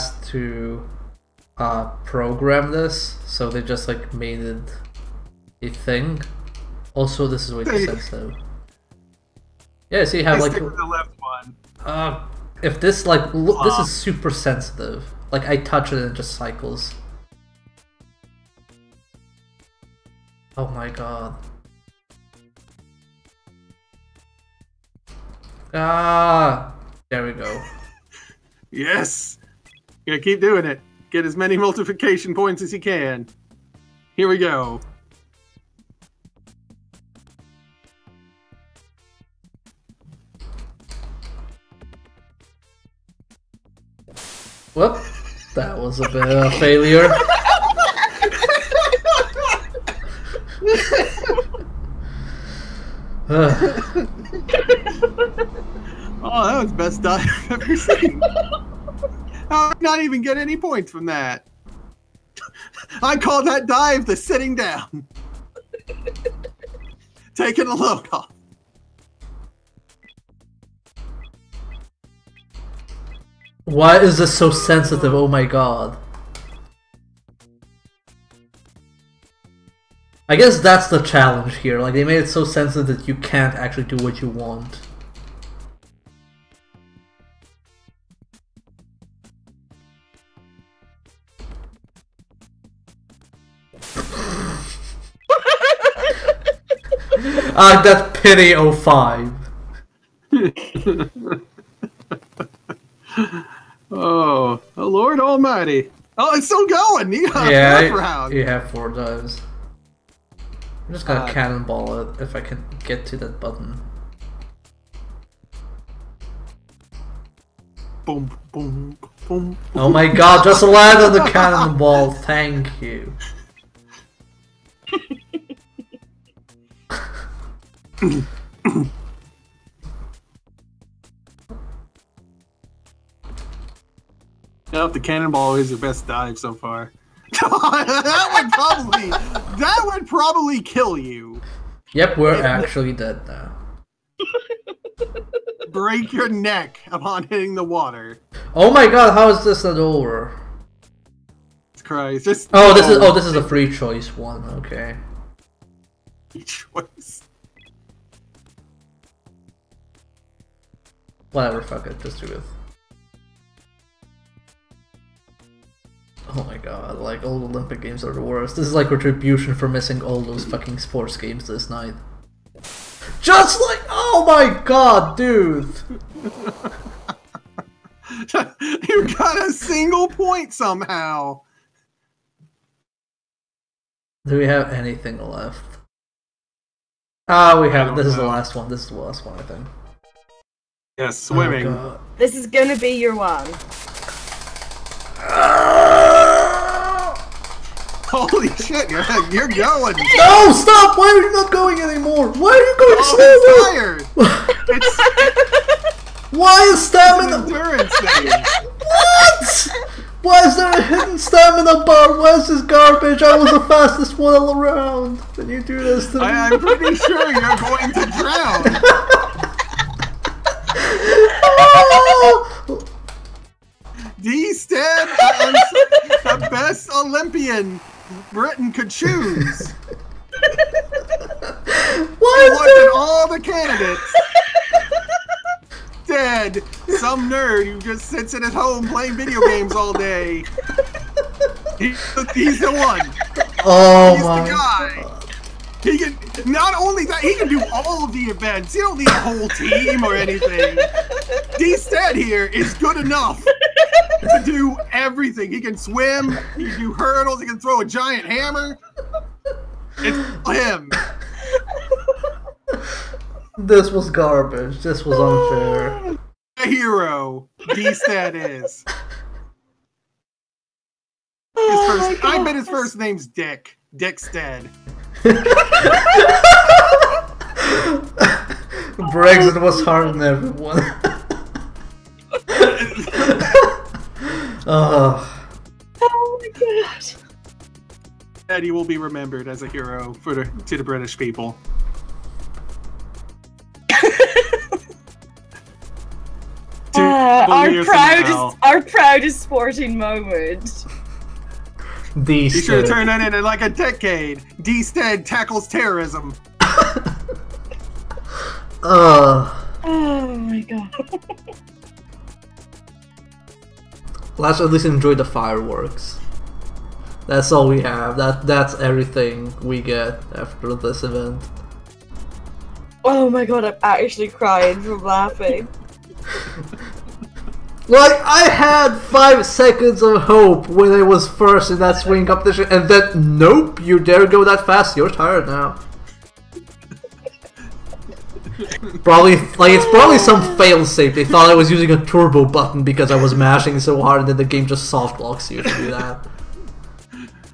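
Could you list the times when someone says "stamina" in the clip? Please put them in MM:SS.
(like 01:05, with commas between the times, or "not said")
03:26, 03:31.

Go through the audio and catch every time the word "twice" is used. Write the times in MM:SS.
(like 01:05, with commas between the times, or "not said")
not said.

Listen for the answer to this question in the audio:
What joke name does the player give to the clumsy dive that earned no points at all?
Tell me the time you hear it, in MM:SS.
01:04.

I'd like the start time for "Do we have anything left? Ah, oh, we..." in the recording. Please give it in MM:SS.
03:04.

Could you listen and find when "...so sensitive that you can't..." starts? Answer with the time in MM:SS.
01:22.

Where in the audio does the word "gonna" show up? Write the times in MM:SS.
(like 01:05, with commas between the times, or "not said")
01:51, 03:12.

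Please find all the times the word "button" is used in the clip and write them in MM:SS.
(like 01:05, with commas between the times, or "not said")
01:53, 05:42.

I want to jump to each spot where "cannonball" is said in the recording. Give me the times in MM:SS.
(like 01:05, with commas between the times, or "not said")
01:51, 02:01, 02:15.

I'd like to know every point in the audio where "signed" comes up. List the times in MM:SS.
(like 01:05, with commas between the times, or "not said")
not said.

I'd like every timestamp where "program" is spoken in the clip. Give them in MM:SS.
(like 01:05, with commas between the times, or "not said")
00:02.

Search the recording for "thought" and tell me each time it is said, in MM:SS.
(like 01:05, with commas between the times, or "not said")
05:41.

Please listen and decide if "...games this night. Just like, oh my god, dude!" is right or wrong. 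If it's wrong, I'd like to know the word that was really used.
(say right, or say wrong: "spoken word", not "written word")
right.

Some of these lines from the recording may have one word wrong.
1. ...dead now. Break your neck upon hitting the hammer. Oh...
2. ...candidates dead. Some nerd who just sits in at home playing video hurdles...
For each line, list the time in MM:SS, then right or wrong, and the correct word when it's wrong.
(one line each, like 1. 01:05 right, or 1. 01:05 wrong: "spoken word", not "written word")
1. 02:22 wrong: "water", not "hammer"
2. 03:53 wrong: "games", not "hurdles".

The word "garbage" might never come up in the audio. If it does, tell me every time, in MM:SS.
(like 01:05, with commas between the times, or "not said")
03:32, 04:24.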